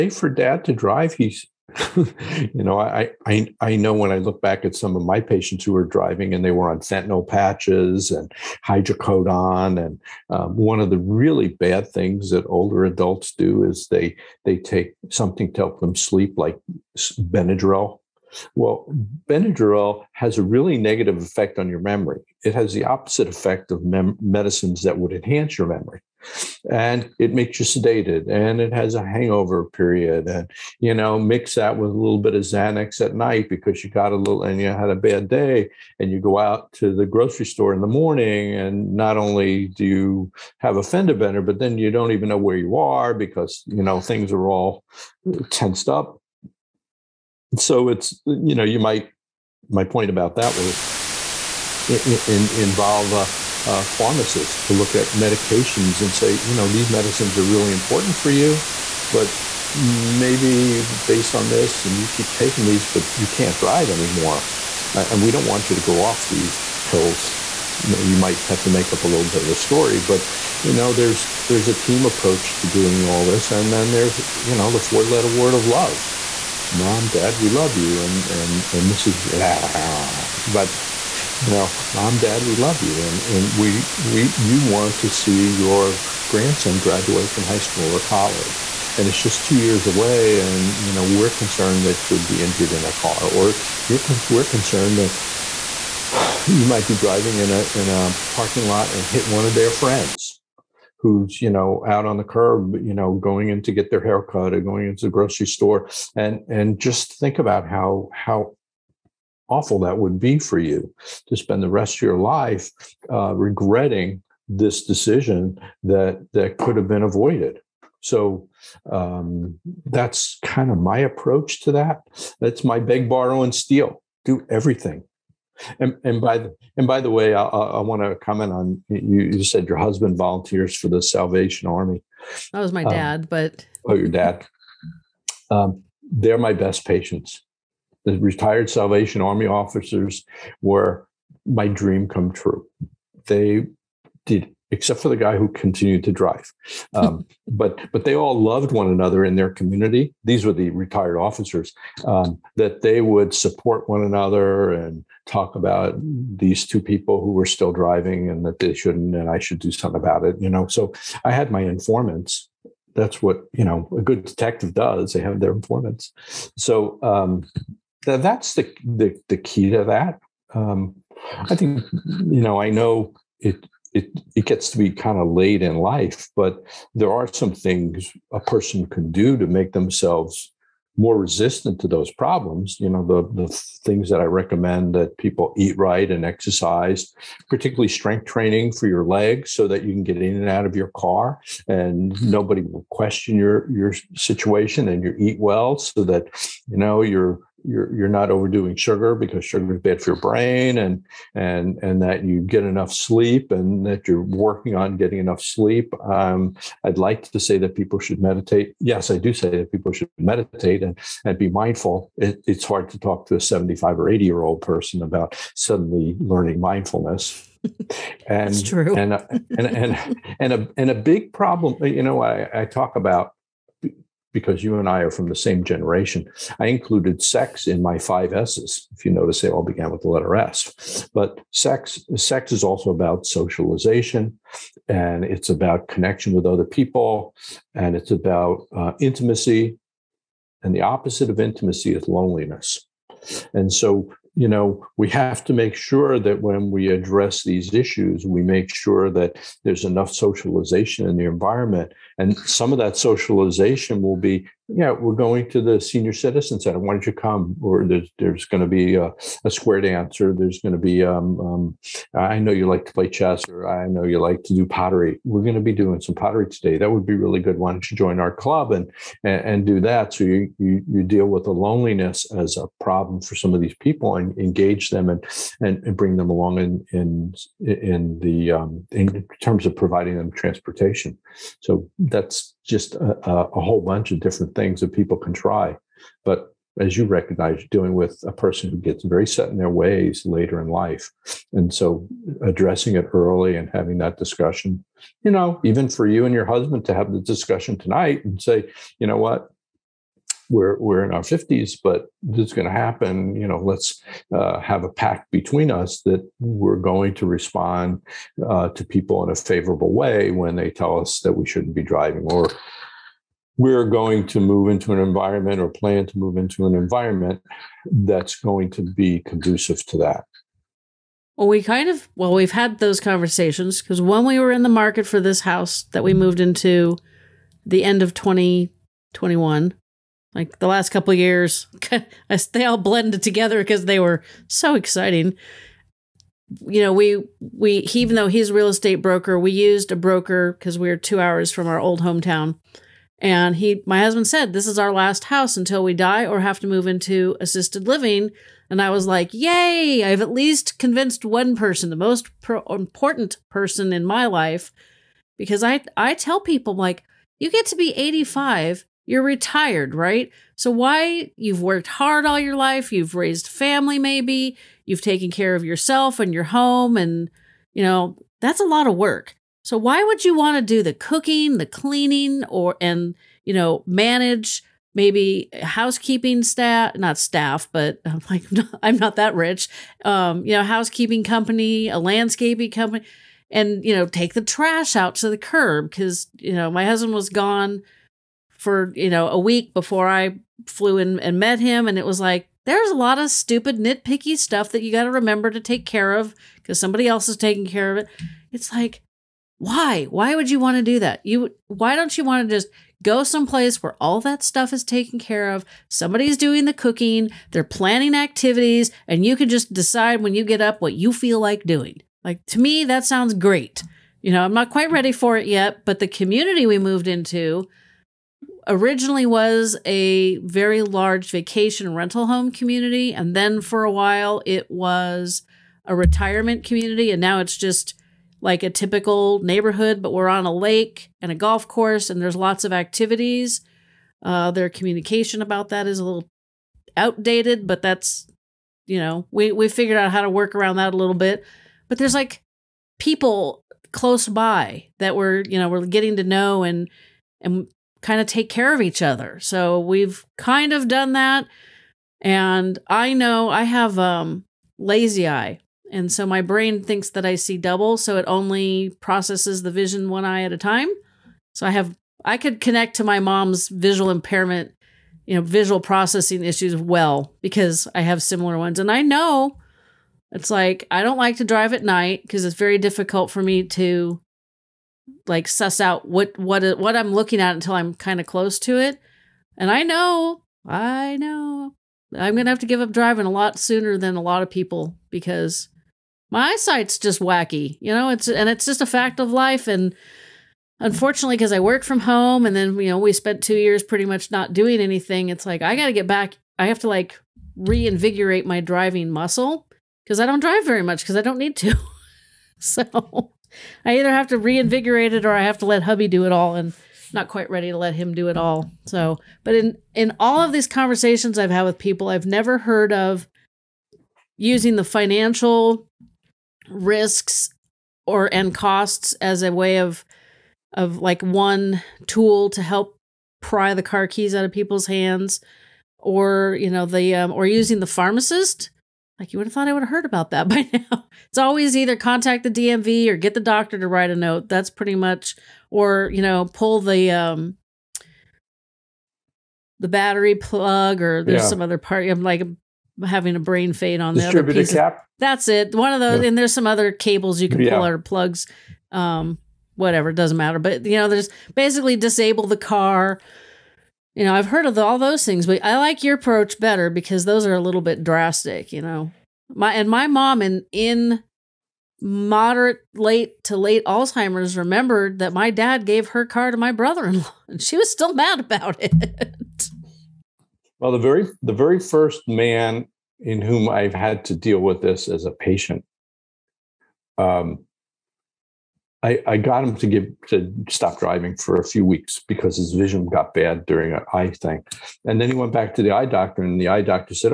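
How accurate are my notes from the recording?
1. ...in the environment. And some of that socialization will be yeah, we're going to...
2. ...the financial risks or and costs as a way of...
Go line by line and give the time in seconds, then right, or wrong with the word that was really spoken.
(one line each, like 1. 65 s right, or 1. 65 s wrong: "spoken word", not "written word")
1. 251 s right
2. 514 s right.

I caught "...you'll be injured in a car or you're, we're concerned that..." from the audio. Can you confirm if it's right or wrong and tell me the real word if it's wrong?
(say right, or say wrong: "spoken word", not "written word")
right.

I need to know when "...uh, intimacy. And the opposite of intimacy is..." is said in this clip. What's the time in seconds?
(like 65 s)
238 s.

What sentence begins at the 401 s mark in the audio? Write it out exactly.
You why don't you want to just go someplace where all that stuff is taken care of.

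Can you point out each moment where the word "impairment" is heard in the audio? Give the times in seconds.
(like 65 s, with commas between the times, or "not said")
464 s.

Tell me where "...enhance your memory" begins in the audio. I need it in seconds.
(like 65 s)
25 s.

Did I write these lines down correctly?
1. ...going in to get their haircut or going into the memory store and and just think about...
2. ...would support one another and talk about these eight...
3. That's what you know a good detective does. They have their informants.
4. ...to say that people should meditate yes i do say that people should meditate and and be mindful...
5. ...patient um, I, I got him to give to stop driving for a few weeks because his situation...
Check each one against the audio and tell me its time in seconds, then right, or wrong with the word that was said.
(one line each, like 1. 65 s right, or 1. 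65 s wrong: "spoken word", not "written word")
1. 103 s wrong: "grocery", not "memory"
2. 153 s wrong: "two", not "eight"
3. 162 s right
4. 207 s right
5. 575 s wrong: "vision", not "situation".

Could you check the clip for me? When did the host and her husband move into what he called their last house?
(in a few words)
end of 2021.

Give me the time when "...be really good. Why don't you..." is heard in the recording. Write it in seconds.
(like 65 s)
267 s.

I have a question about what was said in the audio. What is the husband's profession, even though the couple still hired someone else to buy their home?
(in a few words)
real estate broker.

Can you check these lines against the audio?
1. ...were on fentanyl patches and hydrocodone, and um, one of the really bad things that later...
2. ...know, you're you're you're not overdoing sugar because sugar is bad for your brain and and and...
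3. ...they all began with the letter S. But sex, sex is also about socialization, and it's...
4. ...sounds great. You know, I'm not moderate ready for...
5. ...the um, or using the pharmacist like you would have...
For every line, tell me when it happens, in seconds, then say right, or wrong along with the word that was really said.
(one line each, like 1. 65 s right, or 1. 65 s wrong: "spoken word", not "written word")
1. 6 s wrong: "older", not "later"
2. 196 s right
3. 229 s right
4. 413 s wrong: "quite", not "moderate"
5. 526 s right.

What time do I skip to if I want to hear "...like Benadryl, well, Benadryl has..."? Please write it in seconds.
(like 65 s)
16 s.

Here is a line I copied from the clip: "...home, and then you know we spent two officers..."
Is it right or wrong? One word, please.
wrong.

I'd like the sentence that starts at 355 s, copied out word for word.
Because I, I tell people, like, you get to be 85 you're retired, right?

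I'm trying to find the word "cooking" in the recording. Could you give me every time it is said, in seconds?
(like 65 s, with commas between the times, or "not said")
370 s, 406 s.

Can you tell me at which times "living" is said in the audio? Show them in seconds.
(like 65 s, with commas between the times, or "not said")
347 s.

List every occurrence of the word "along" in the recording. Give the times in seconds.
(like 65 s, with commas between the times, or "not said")
276 s.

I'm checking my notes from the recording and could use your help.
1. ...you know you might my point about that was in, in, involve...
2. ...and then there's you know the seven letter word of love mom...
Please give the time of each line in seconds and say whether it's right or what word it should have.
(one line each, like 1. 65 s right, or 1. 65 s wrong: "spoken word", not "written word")
1. 48 s right
2. 73 s wrong: "four", not "seven".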